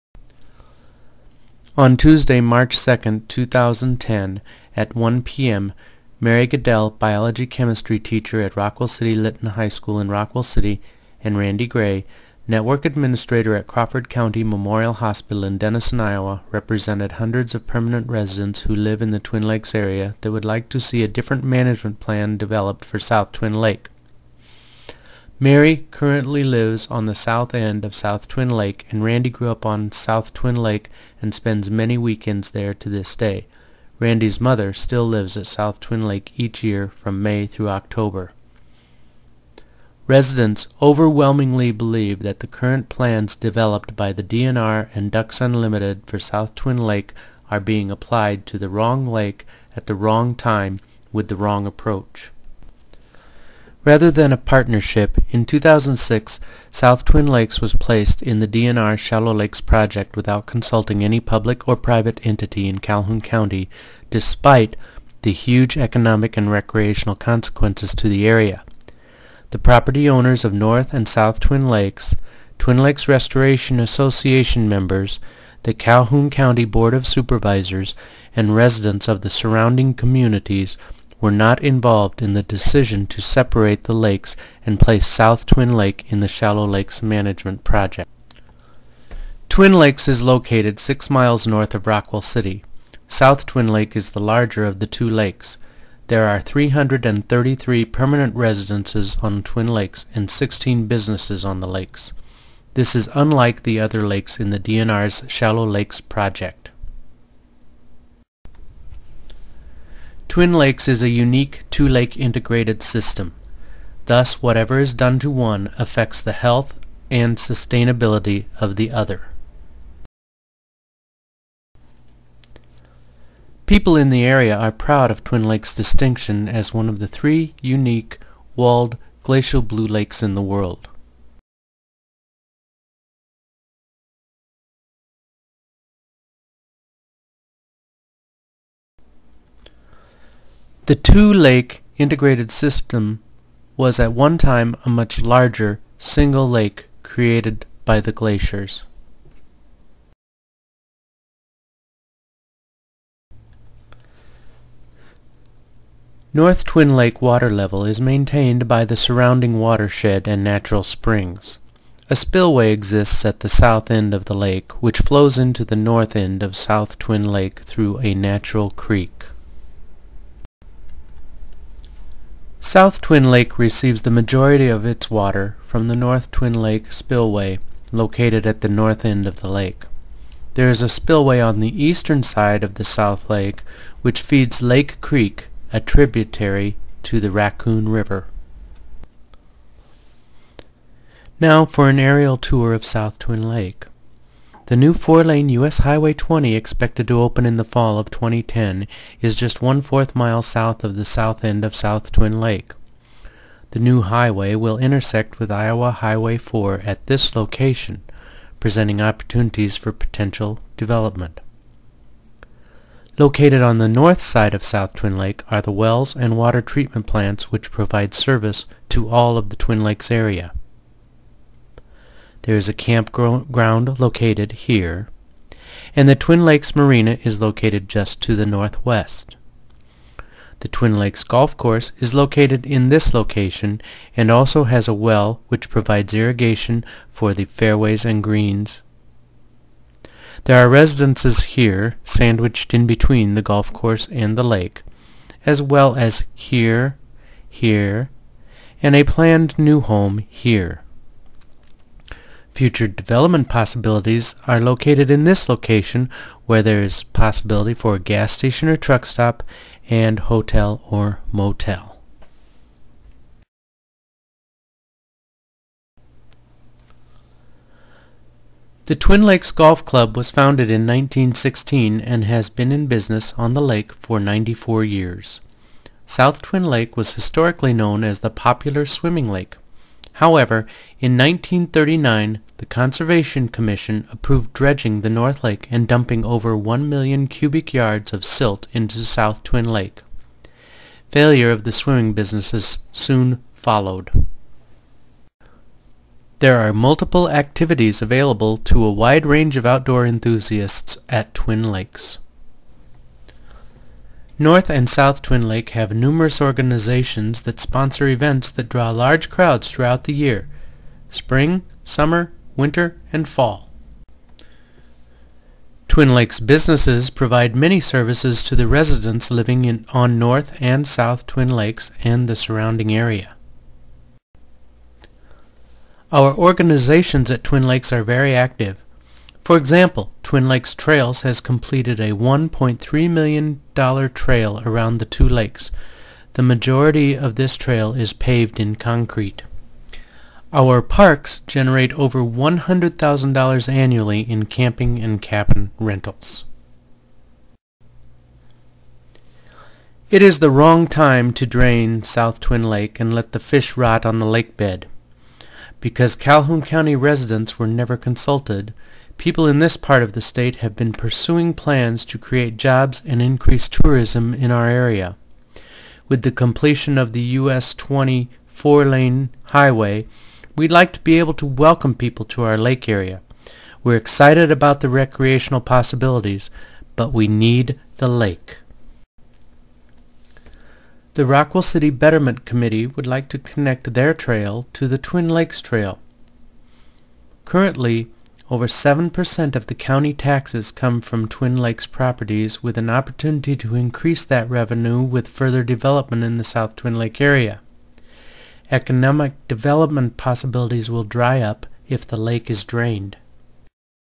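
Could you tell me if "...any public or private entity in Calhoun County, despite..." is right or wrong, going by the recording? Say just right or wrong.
right.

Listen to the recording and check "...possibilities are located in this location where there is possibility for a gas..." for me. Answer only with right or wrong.
right.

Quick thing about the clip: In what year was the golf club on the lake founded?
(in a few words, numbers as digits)
1916.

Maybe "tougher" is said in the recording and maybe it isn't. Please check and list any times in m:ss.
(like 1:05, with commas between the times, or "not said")
not said.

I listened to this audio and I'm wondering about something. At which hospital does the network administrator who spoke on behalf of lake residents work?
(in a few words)
Crawford County Memorial Hospital.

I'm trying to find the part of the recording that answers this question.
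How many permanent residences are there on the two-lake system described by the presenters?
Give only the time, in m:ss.
1:36.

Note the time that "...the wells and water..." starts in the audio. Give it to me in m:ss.
3:35.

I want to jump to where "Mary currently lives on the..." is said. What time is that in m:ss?
0:25.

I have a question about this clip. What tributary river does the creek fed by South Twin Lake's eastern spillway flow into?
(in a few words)
Raccoon River.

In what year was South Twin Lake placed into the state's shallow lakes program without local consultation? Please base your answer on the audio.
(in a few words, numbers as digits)
2006.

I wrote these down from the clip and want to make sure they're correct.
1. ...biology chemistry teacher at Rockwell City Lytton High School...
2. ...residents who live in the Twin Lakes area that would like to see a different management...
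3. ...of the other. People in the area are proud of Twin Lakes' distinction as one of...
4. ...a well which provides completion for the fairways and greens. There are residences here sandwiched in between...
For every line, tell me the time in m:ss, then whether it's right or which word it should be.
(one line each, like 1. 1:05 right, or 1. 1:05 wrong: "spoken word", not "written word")
1. 0:06 right
2. 0:18 right
3. 1:58 right
4. 3:54 wrong: "irrigation", not "completion".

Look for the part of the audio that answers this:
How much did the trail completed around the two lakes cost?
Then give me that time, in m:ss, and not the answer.
5:32.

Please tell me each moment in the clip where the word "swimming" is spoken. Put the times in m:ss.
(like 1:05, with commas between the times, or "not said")
4:38, 4:51.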